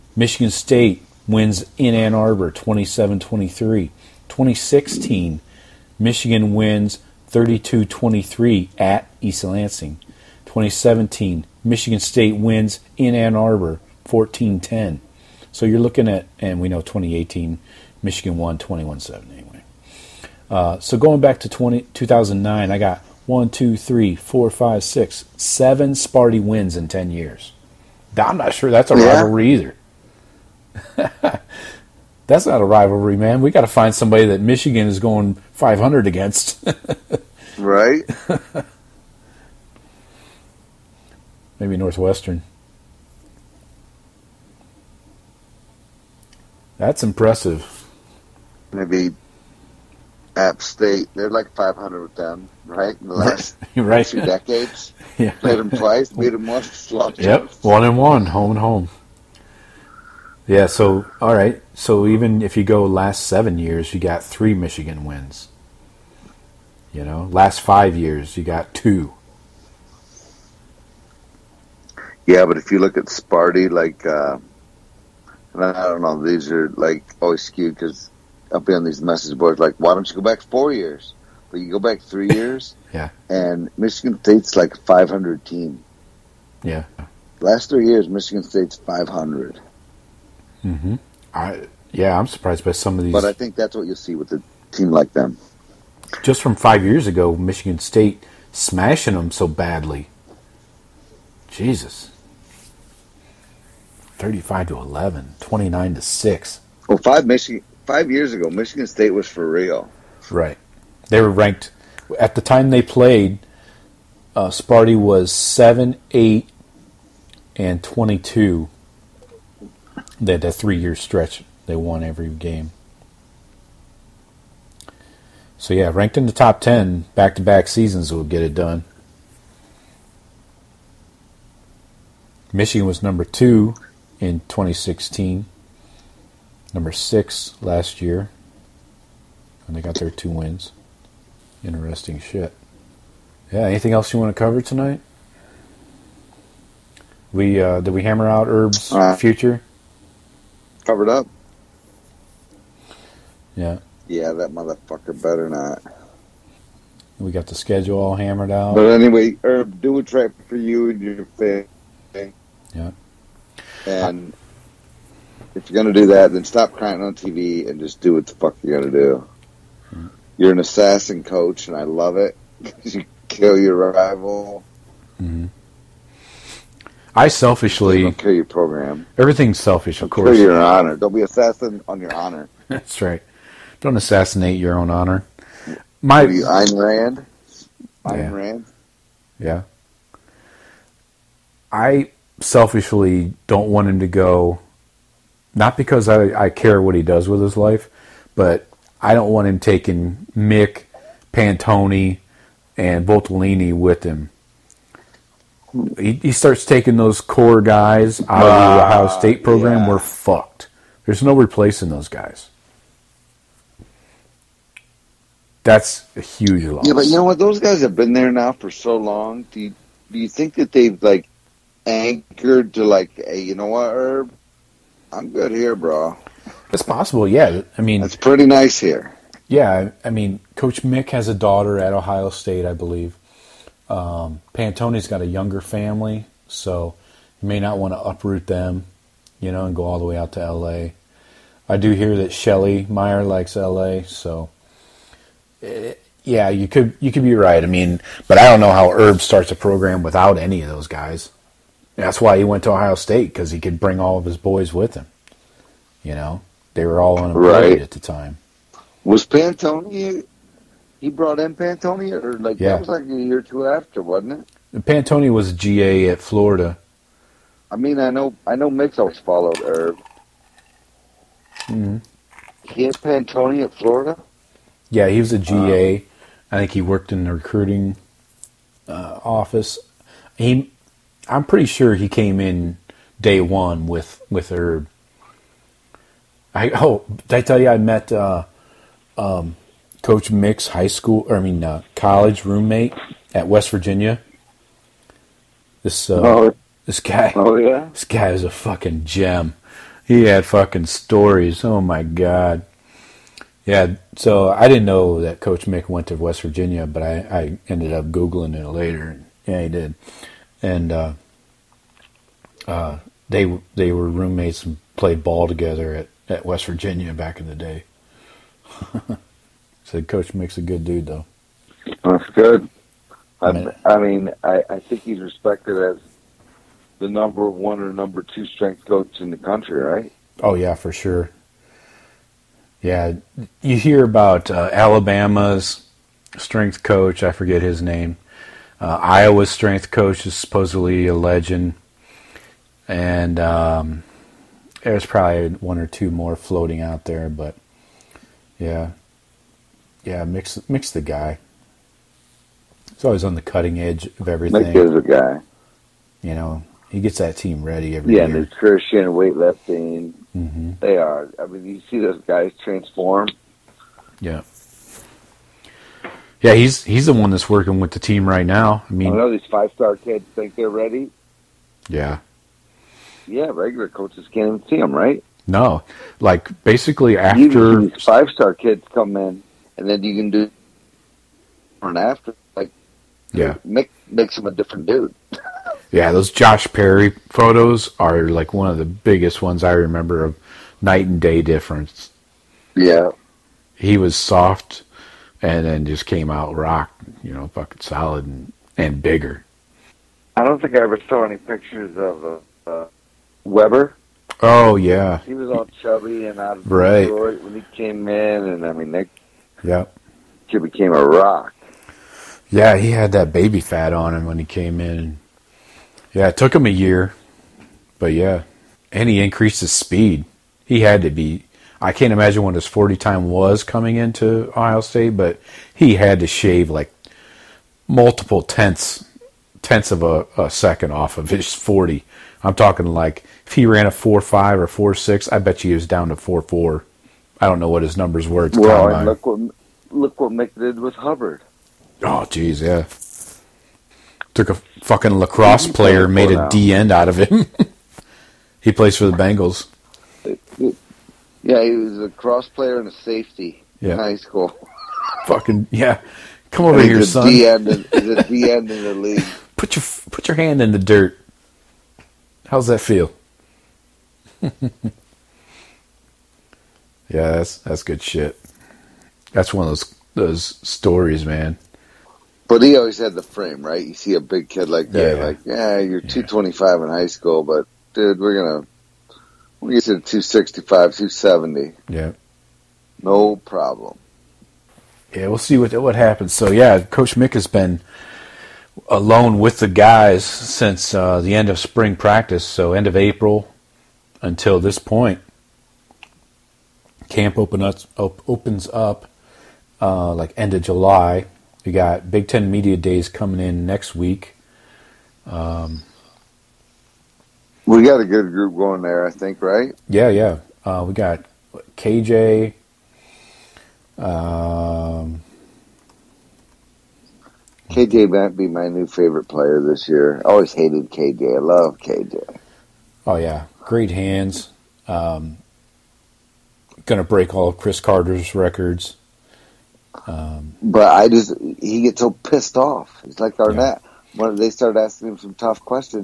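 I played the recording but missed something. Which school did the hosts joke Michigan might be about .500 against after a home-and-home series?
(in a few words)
App State.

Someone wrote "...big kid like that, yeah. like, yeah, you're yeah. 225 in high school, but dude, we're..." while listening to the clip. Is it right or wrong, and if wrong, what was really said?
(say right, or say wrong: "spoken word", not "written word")
right.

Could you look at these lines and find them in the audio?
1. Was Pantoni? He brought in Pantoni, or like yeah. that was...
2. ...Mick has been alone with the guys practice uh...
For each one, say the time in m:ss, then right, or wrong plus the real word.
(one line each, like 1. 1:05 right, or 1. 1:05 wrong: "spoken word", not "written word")
1. 4:19 right
2. 8:07 wrong: "since", not "practice".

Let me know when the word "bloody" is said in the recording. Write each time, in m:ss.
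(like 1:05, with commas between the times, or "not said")
not said.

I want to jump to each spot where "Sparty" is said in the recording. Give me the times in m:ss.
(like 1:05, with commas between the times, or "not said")
0:25, 1:13, 1:54.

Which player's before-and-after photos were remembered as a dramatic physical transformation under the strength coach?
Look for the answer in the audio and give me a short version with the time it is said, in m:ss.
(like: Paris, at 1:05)
Josh Perry, at 6:26.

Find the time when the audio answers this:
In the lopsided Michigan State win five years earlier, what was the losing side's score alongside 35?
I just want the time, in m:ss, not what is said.
1:44.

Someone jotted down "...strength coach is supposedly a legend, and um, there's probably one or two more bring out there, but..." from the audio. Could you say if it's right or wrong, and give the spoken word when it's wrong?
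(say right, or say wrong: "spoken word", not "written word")
wrong: "floating", not "bring".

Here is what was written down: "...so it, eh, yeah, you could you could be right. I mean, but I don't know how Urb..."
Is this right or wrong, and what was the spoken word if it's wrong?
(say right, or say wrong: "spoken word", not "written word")
right.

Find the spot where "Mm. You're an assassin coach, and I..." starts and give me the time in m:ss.
2:49.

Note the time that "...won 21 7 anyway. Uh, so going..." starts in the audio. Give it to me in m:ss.
0:18.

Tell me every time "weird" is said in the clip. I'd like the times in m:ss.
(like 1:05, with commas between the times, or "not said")
not said.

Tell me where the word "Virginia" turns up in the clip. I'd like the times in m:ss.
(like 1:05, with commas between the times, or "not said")
4:53, 5:06, 5:16.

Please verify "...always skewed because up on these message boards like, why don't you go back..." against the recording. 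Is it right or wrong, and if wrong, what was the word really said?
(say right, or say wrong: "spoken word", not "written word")
right.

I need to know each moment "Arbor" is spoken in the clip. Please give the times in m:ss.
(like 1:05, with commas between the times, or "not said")
0:02, 0:13.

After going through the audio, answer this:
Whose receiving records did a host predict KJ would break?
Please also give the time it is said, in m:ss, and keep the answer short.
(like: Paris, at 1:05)
Cris Carter, at 8:47.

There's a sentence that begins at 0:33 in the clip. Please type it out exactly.
We got to find somebody that Michigan is going 500 against.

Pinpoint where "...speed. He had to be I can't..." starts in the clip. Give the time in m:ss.
6:59.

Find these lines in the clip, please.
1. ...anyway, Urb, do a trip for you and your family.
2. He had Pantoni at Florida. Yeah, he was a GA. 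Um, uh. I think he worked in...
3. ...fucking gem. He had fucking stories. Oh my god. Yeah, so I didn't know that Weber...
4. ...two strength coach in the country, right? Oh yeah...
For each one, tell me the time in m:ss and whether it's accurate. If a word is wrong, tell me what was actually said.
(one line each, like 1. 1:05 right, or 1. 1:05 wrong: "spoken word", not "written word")
1. 2:38 right
2. 4:32 right
3. 4:58 wrong: "Coach", not "Weber"
4. 5:28 right.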